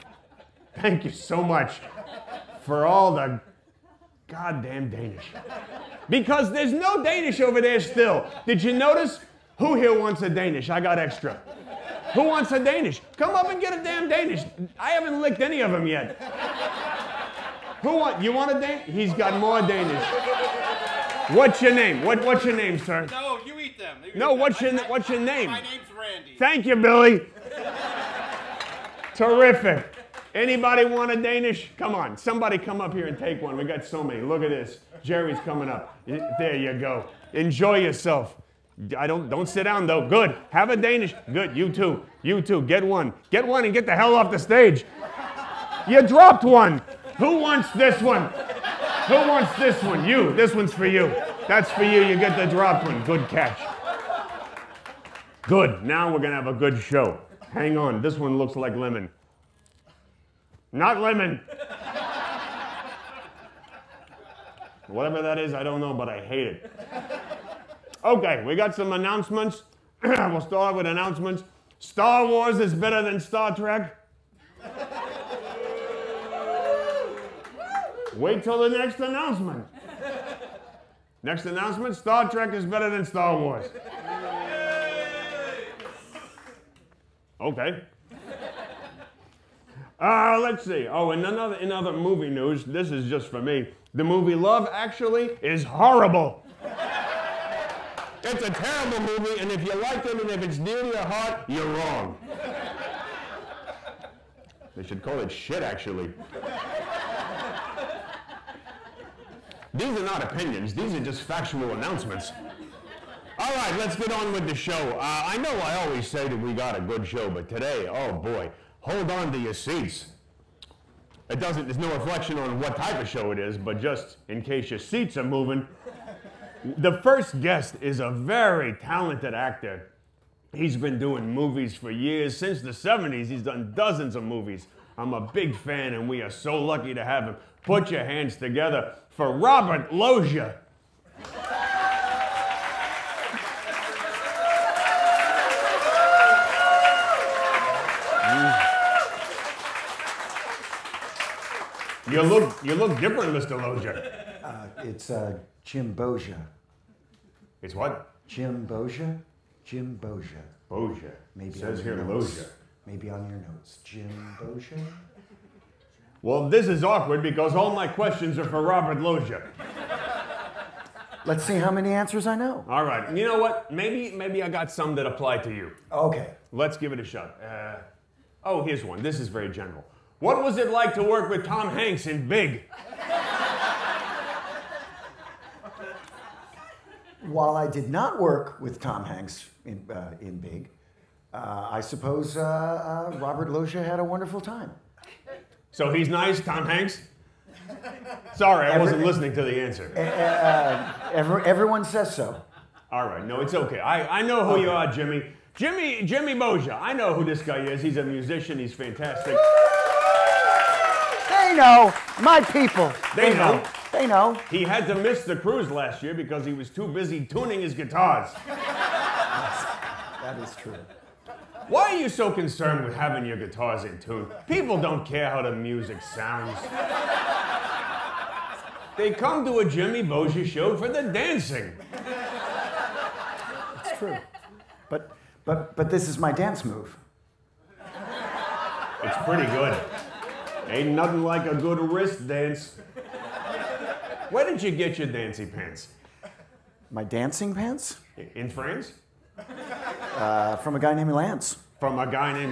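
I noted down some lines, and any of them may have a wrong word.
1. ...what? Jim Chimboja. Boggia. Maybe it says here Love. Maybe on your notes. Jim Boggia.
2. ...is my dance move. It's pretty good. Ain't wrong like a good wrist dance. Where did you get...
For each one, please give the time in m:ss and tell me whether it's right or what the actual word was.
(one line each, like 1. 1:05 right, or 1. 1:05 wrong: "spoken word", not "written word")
1. 2:37 wrong: "Loggia", not "Love"
2. 3:56 wrong: "nothing", not "wrong".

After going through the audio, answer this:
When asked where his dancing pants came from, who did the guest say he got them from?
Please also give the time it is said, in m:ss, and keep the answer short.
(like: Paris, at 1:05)
a guy named Lance, at 4:10.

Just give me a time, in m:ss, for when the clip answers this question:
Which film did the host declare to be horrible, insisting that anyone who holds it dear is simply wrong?
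1:34.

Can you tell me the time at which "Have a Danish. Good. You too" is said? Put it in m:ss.
0:40.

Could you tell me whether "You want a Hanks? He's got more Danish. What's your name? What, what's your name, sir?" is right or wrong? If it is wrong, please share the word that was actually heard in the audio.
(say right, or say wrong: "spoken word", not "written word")
wrong: "Danish", not "Hanks".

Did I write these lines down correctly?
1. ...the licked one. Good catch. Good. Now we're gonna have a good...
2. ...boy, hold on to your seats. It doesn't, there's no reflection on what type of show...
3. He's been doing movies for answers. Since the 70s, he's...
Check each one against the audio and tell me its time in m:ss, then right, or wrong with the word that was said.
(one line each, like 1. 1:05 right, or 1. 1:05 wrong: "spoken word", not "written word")
1. 0:52 wrong: "dropped", not "licked"
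2. 1:58 right
3. 2:10 wrong: "years", not "answers".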